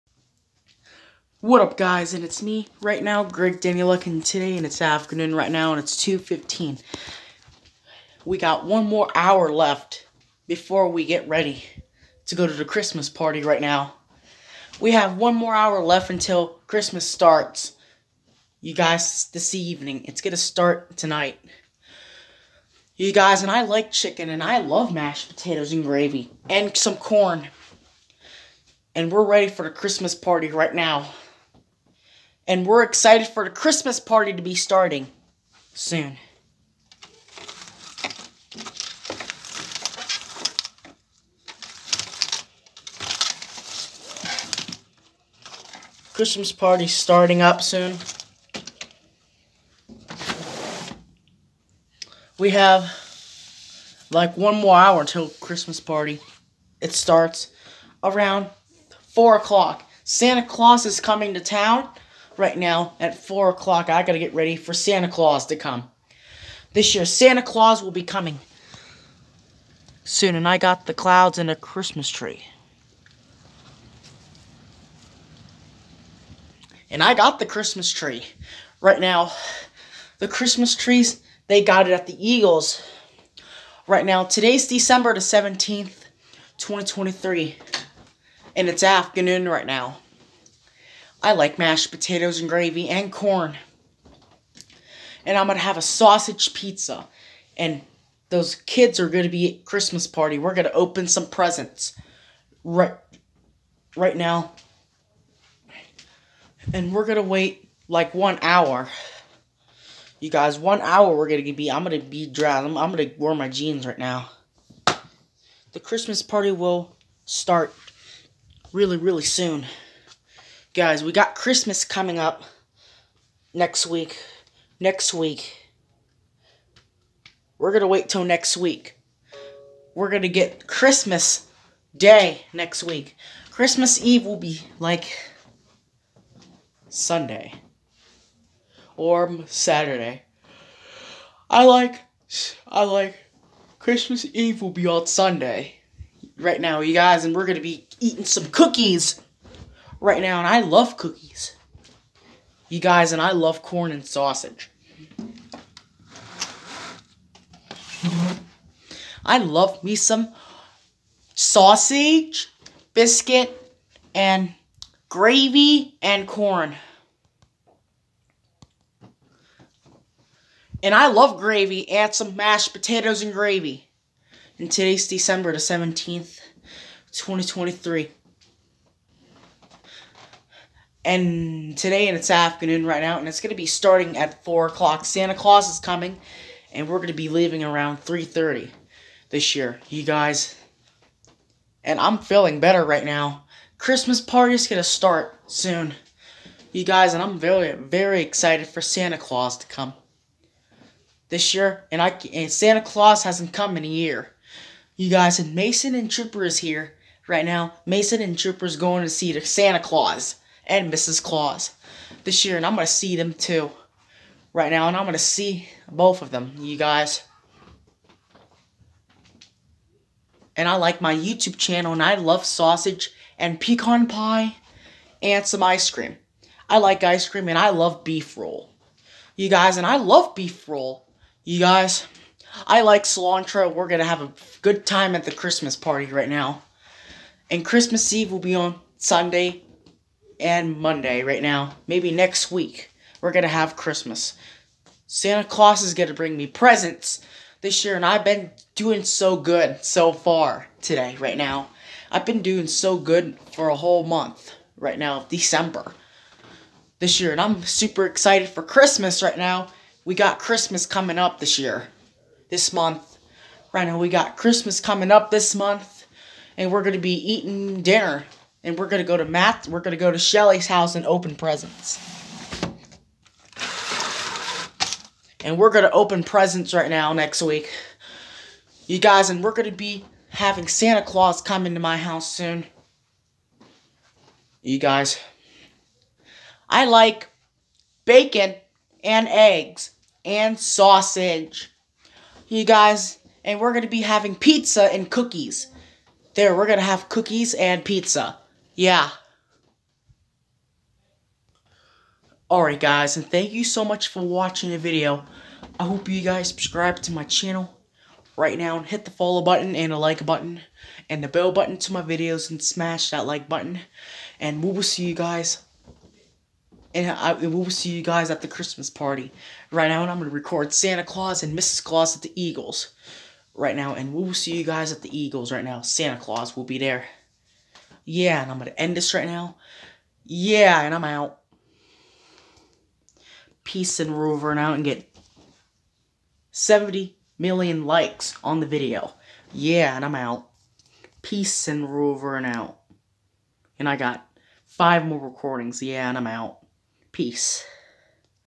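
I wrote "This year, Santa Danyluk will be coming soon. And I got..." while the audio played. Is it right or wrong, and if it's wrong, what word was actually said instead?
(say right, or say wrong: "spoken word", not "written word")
wrong: "Claus", not "Danyluk".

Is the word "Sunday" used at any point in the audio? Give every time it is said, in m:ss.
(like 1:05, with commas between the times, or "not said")
2:16, 2:25, 3:58.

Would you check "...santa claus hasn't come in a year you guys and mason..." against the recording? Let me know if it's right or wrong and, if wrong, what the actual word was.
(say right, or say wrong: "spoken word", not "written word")
right.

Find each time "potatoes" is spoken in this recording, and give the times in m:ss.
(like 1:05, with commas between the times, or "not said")
0:25, 1:31, 2:52.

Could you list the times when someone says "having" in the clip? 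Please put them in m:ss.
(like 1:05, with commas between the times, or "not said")
4:40, 4:54.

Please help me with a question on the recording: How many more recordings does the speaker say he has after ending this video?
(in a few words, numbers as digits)
5.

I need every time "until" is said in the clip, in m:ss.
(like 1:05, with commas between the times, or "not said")
0:16, 0:54.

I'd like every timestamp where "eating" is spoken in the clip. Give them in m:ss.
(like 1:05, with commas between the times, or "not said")
2:27, 4:27.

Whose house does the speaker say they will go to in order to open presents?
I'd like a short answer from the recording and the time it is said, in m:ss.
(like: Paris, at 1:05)
Shelly's, at 4:30.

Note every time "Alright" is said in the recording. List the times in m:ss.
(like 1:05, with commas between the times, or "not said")
5:02.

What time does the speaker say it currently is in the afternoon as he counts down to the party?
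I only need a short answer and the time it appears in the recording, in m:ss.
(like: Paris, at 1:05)
2:15, at 0:05.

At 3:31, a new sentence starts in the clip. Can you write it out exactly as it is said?
Claus this year, and I'm going to see them too right now, and I'm going to see both of them, you guys.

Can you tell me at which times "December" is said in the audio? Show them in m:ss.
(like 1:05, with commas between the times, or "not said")
1:24, 2:55, 4:15.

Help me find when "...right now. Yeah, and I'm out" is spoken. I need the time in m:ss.
5:29.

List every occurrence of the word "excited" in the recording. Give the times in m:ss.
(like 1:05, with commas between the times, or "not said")
0:32, 3:18, 4:18.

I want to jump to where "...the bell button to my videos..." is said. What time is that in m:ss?
5:11.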